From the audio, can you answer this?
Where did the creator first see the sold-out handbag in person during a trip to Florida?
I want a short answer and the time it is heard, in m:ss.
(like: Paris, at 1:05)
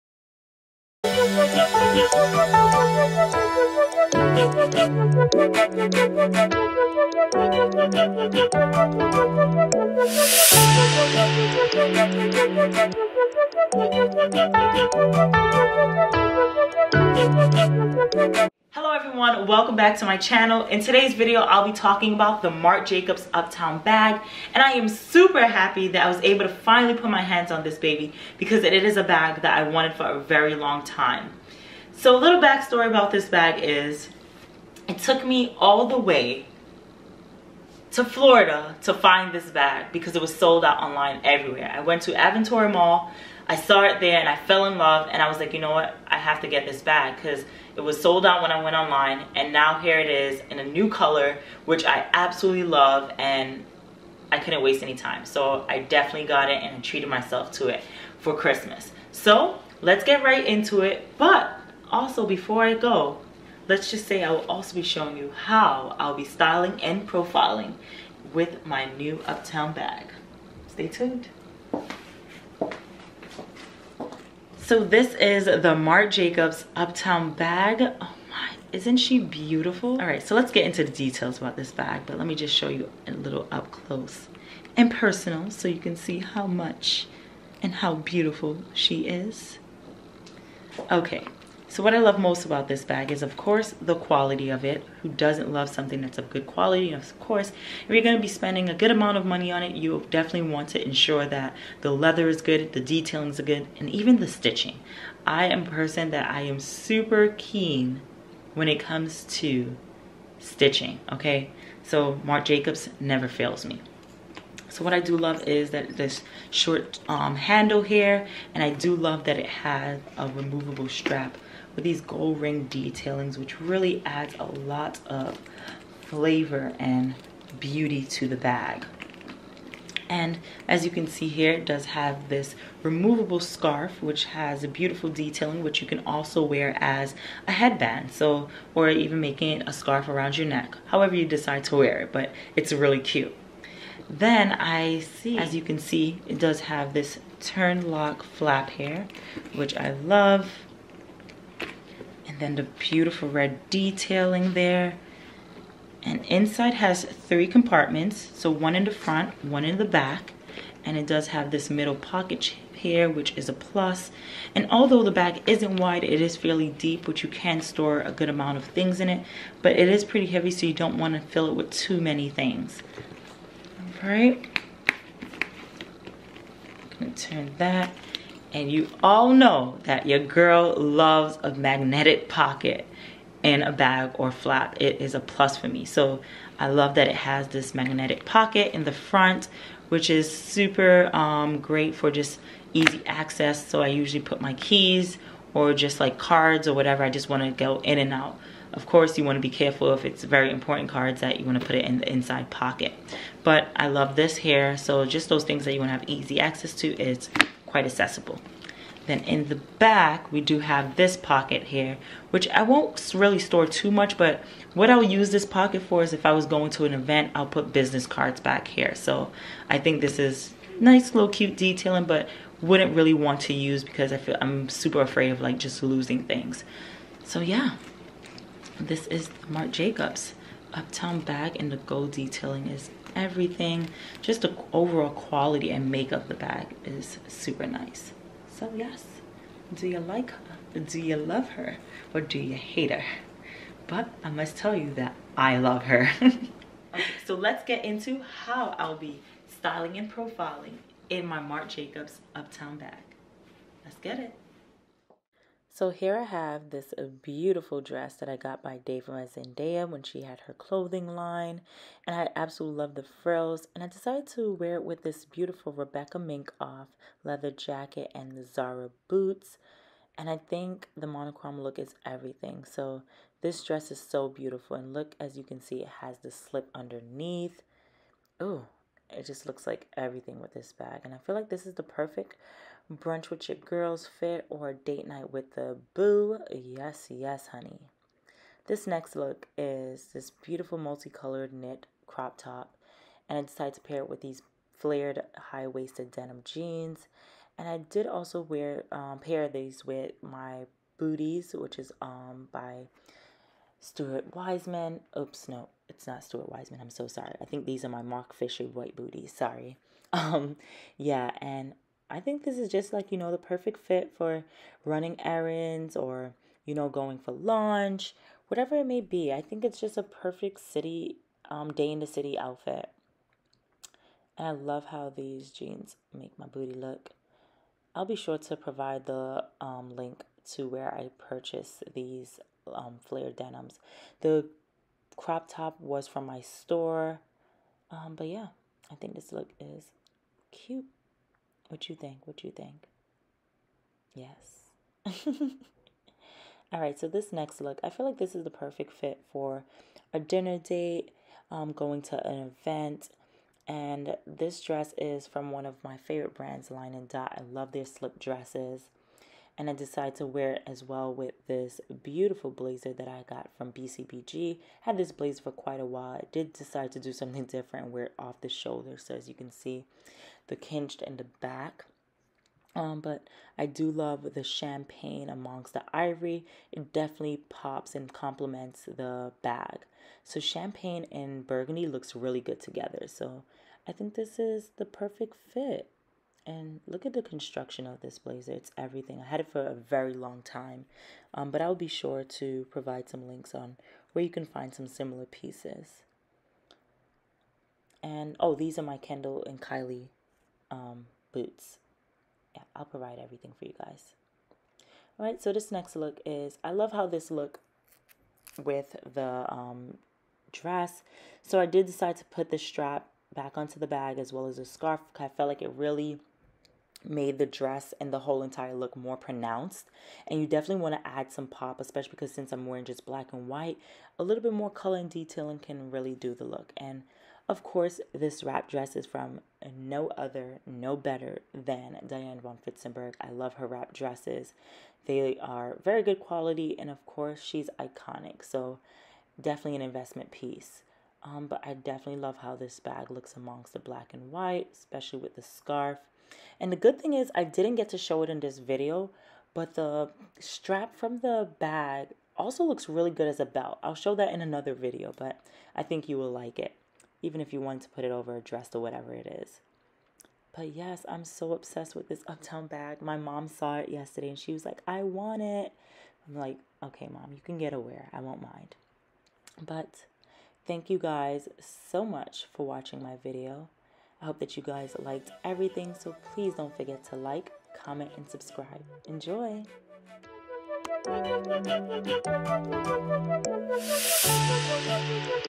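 Aventura Mall, at 0:42.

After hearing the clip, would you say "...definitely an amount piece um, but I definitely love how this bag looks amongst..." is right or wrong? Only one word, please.
wrong.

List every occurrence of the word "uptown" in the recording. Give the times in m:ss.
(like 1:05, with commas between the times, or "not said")
0:23, 1:09, 1:16, 3:50, 4:12, 7:42.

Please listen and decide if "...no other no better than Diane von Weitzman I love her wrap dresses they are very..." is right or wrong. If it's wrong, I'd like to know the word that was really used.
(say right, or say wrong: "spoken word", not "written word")
wrong: "Furstenberg", not "Weitzman".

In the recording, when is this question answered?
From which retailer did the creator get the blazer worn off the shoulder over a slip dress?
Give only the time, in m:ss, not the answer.
6:03.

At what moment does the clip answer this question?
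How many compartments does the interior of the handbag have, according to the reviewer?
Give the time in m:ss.
2:37.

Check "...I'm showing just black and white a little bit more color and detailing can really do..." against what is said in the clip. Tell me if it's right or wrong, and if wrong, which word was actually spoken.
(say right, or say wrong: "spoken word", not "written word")
wrong: "wearing", not "showing".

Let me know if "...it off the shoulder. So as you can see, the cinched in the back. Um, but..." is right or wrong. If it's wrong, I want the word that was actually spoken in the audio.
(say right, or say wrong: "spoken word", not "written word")
right.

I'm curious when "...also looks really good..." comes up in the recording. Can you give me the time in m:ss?
7:32.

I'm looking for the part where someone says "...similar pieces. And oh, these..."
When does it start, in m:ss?
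6:34.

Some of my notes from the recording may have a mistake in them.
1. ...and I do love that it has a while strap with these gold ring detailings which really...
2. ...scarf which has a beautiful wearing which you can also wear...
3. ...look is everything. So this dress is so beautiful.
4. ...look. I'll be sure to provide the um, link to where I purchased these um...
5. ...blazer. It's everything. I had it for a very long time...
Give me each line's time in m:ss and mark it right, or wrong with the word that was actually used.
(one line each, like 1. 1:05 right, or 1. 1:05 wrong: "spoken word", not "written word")
1. 1:58 wrong: "removable", not "while"
2. 2:13 wrong: "detailing", not "wearing"
3. 4:31 right
4. 5:26 right
5. 6:28 right.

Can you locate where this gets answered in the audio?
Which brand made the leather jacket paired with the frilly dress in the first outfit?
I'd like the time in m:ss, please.
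4:25.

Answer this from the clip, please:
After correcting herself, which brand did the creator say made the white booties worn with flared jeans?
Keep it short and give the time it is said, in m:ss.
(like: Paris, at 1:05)
Marc Fisher, at 5:08.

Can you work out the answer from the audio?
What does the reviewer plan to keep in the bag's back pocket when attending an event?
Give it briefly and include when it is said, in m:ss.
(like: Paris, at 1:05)
business cards, at 3:37.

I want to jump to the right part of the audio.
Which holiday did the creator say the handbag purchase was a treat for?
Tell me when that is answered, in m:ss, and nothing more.
0:58.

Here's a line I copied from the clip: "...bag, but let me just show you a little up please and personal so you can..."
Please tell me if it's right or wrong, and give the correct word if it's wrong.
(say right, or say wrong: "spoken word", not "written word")
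wrong: "close", not "please".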